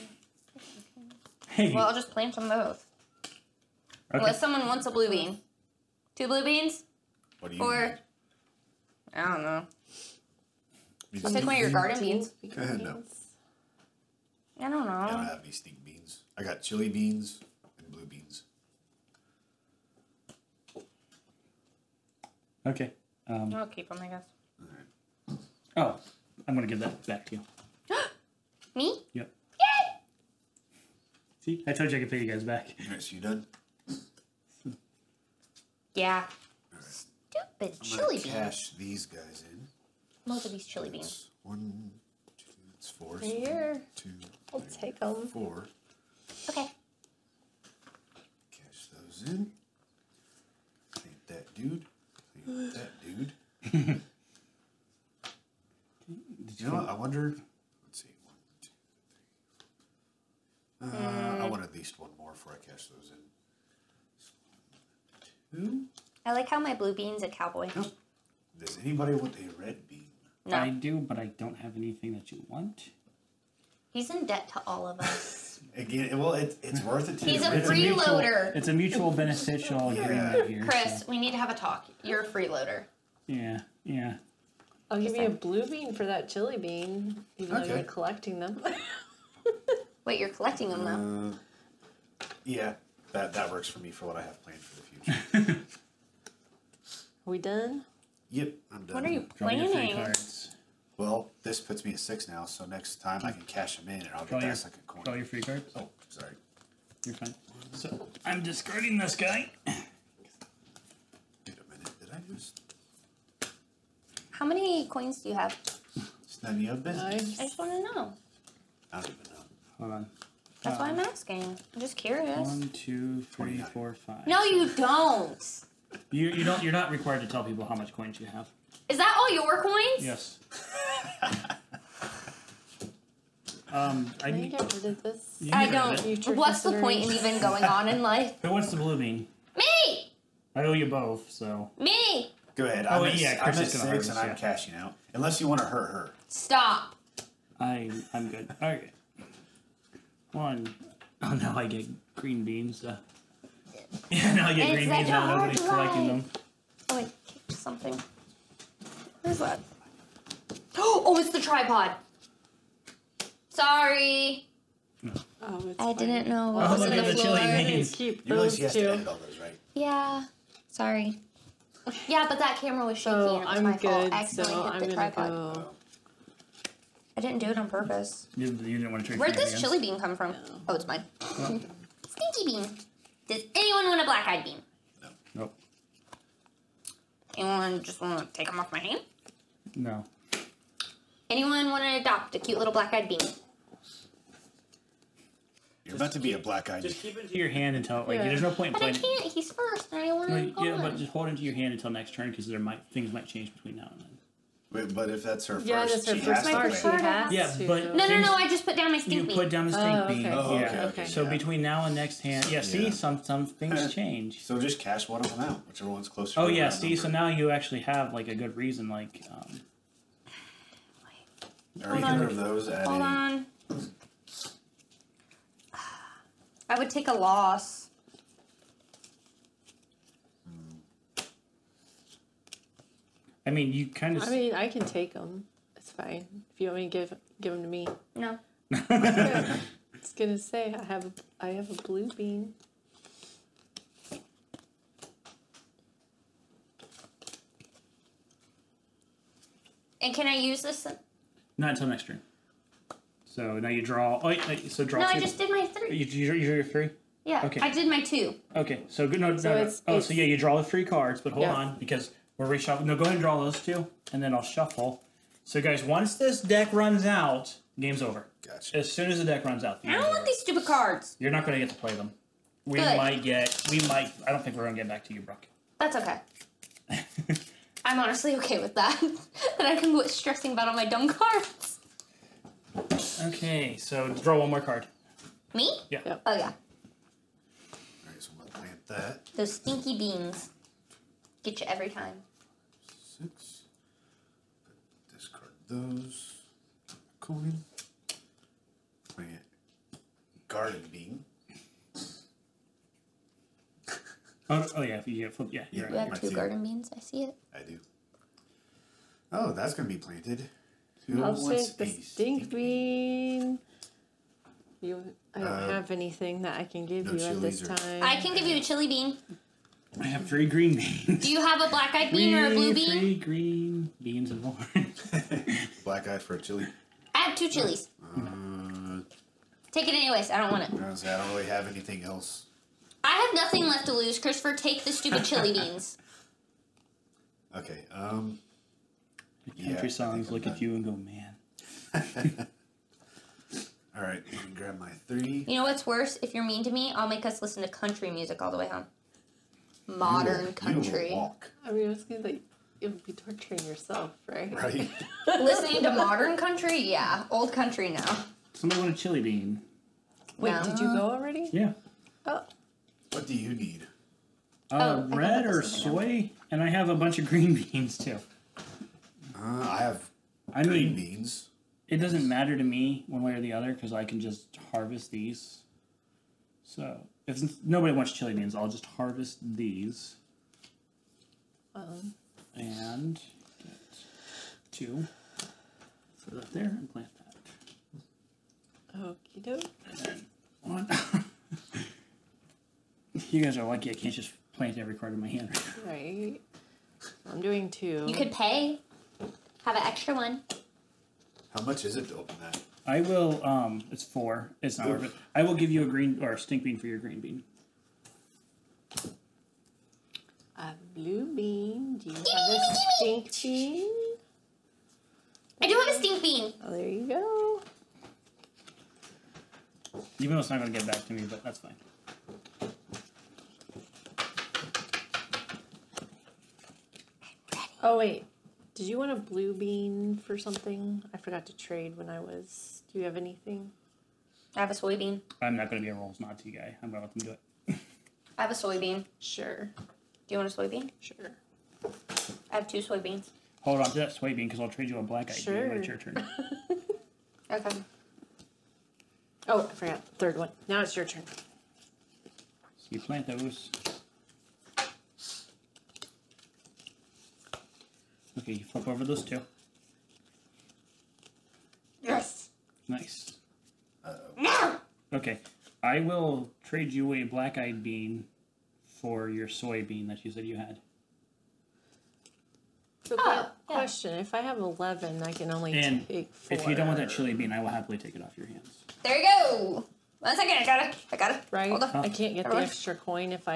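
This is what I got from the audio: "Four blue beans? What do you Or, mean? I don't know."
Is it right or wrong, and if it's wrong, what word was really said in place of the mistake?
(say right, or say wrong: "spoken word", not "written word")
wrong: "Two", not "Four".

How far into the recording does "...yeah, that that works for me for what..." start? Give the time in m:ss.
1:32.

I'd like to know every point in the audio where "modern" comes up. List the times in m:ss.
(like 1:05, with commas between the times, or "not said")
5:49, 5:55.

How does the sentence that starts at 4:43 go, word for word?
Okay, so draw one more card.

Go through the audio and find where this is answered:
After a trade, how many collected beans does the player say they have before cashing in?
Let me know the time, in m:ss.
1:41.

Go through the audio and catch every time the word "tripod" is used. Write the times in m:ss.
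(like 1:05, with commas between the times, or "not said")
2:41, 2:54.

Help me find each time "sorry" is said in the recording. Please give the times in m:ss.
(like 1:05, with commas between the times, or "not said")
1:46, 2:43, 2:50.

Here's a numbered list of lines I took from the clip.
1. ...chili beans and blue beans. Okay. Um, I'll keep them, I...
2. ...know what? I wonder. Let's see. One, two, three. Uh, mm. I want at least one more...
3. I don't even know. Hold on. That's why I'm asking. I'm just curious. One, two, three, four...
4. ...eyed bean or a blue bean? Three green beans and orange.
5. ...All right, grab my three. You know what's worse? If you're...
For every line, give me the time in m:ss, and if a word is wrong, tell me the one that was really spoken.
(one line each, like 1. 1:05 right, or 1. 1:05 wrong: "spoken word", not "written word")
1. 0:16 right
2. 0:56 right
3. 1:58 right
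4. 5:21 right
5. 5:43 right.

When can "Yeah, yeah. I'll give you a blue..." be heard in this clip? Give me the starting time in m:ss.
1:23.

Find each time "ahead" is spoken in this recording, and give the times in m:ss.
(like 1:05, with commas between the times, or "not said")
2:22, 4:23.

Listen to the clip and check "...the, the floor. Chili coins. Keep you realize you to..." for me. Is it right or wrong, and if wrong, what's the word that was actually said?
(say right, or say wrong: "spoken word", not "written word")
wrong: "beans", not "coins".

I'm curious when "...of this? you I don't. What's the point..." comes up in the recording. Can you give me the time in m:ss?
2:14.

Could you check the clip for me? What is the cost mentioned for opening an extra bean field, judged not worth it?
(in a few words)
4.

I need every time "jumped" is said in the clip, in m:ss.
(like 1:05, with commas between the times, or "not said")
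not said.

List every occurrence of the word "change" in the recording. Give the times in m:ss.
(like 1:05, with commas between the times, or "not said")
3:23, 3:33.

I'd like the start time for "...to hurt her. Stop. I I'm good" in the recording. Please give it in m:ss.
2:25.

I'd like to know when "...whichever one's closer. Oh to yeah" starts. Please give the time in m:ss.
3:35.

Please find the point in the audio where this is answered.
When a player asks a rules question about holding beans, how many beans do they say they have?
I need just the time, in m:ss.
7:54.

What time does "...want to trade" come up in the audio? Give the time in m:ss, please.
2:58.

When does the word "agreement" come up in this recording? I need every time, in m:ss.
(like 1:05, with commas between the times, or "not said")
1:19.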